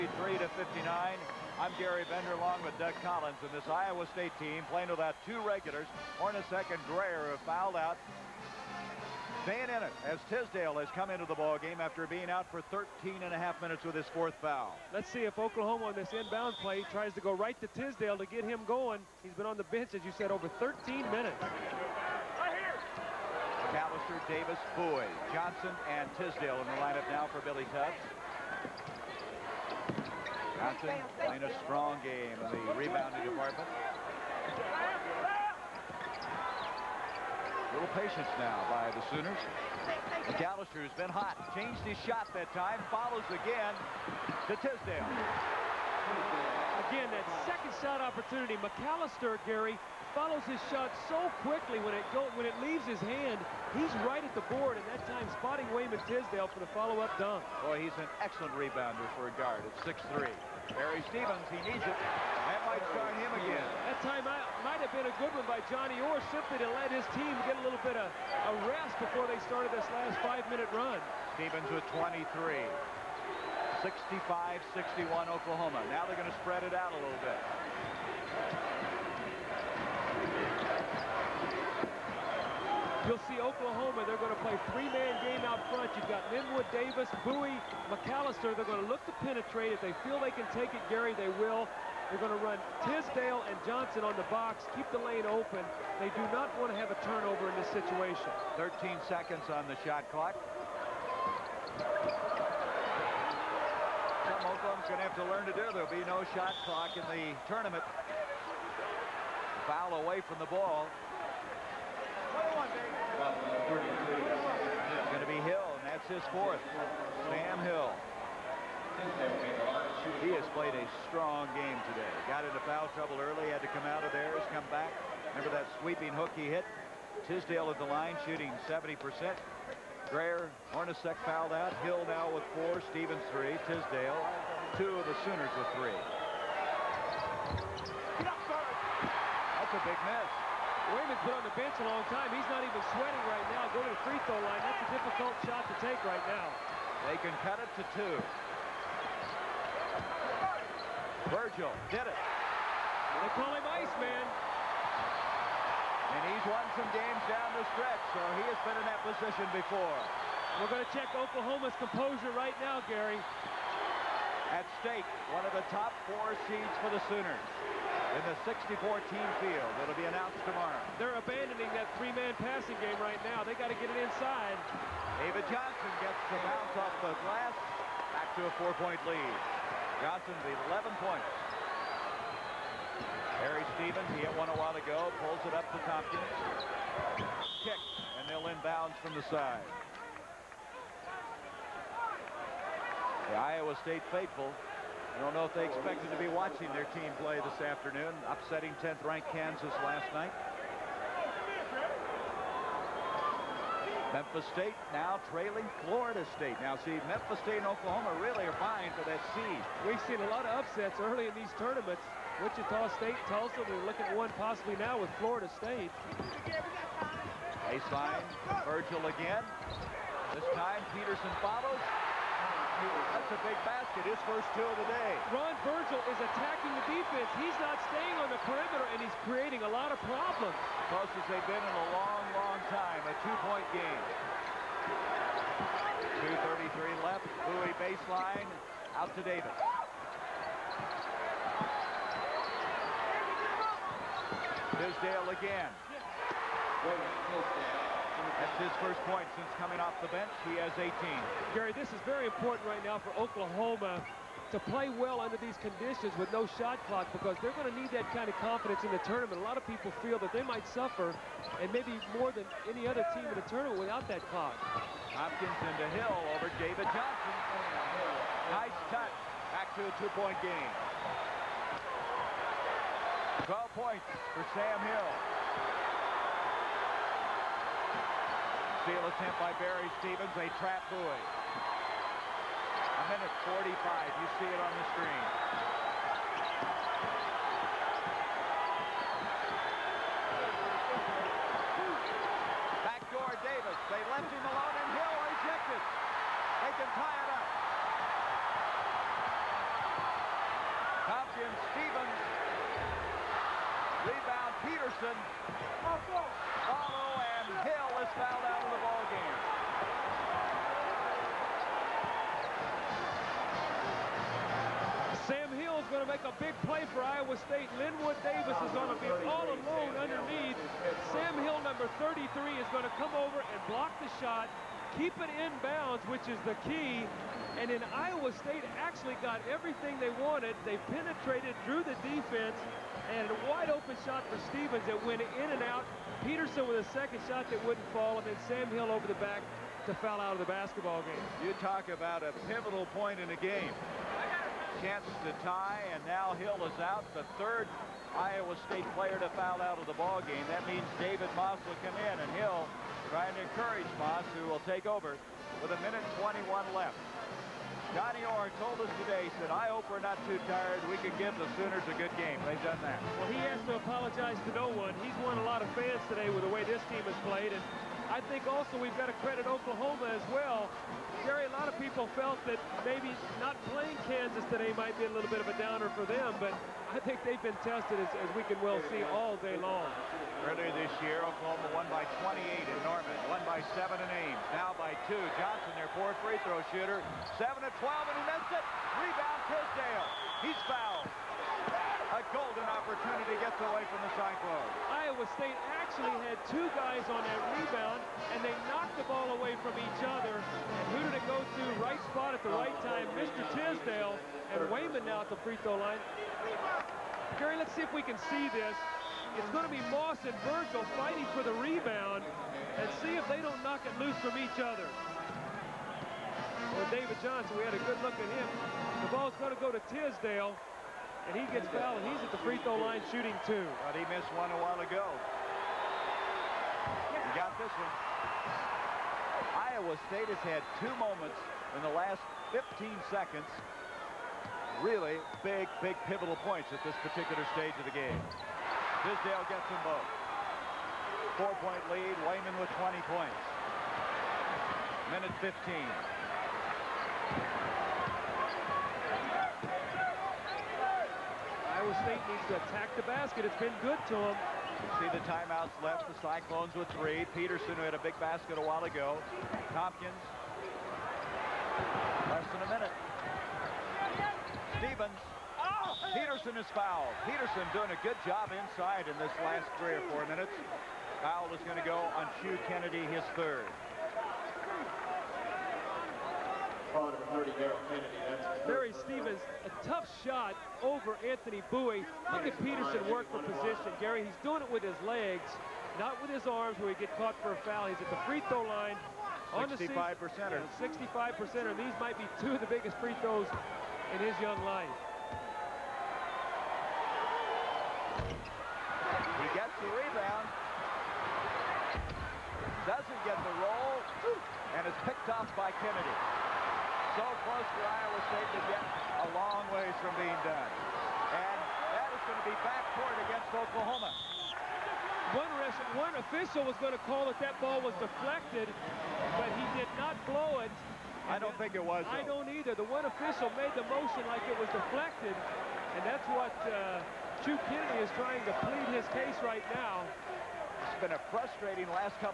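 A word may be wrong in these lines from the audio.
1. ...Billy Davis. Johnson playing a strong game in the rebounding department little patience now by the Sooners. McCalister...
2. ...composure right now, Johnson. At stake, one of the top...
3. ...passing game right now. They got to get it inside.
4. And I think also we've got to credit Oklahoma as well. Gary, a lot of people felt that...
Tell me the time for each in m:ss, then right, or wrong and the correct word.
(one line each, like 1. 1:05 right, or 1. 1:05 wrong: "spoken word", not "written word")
1. 0:27 wrong: "Tubbs", not "Davis"
2. 2:41 wrong: "Gary", not "Johnson"
3. 2:52 right
4. 6:07 right.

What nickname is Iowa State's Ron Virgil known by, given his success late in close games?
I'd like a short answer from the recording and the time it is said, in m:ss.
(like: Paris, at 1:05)
Iceman, at 2:33.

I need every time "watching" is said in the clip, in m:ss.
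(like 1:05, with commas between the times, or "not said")
3:16.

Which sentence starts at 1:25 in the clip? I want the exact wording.
You've got Linwood, Davis, Bowie, McCalister.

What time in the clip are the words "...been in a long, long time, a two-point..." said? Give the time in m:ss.
3:51.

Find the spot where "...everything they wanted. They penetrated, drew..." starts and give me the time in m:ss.
5:29.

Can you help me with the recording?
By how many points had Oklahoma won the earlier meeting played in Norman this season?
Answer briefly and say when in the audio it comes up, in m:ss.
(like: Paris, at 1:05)
28, at 6:22.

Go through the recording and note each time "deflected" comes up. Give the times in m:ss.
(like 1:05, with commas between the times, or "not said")
8:37, 8:44.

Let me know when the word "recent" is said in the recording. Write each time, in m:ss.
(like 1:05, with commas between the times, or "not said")
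not said.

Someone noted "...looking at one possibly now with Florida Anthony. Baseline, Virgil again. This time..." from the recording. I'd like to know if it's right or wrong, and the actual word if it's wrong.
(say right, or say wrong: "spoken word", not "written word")
wrong: "State", not "Anthony".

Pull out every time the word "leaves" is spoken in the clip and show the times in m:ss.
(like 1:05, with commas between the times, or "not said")
0:52.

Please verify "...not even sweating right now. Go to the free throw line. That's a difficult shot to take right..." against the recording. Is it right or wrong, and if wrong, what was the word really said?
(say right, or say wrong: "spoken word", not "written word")
right.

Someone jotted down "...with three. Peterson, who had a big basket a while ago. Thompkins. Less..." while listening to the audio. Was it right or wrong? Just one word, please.
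right.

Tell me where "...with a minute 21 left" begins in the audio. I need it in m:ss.
5:55.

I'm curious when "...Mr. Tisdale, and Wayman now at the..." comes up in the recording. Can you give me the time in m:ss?
6:43.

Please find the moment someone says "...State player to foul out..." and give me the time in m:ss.
5:48.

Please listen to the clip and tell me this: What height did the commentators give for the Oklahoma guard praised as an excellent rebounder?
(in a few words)
6'3".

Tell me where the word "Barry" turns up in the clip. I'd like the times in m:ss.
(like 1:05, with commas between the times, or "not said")
1:00, 3:03, 4:39, 7:58.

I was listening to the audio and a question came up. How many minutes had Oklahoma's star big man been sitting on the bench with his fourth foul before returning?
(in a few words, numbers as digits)
13 and a half.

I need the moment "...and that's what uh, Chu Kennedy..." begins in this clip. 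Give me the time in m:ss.
8:45.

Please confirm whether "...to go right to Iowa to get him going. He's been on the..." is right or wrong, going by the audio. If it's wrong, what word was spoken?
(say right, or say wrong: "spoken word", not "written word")
wrong: "Tisdale", not "Iowa".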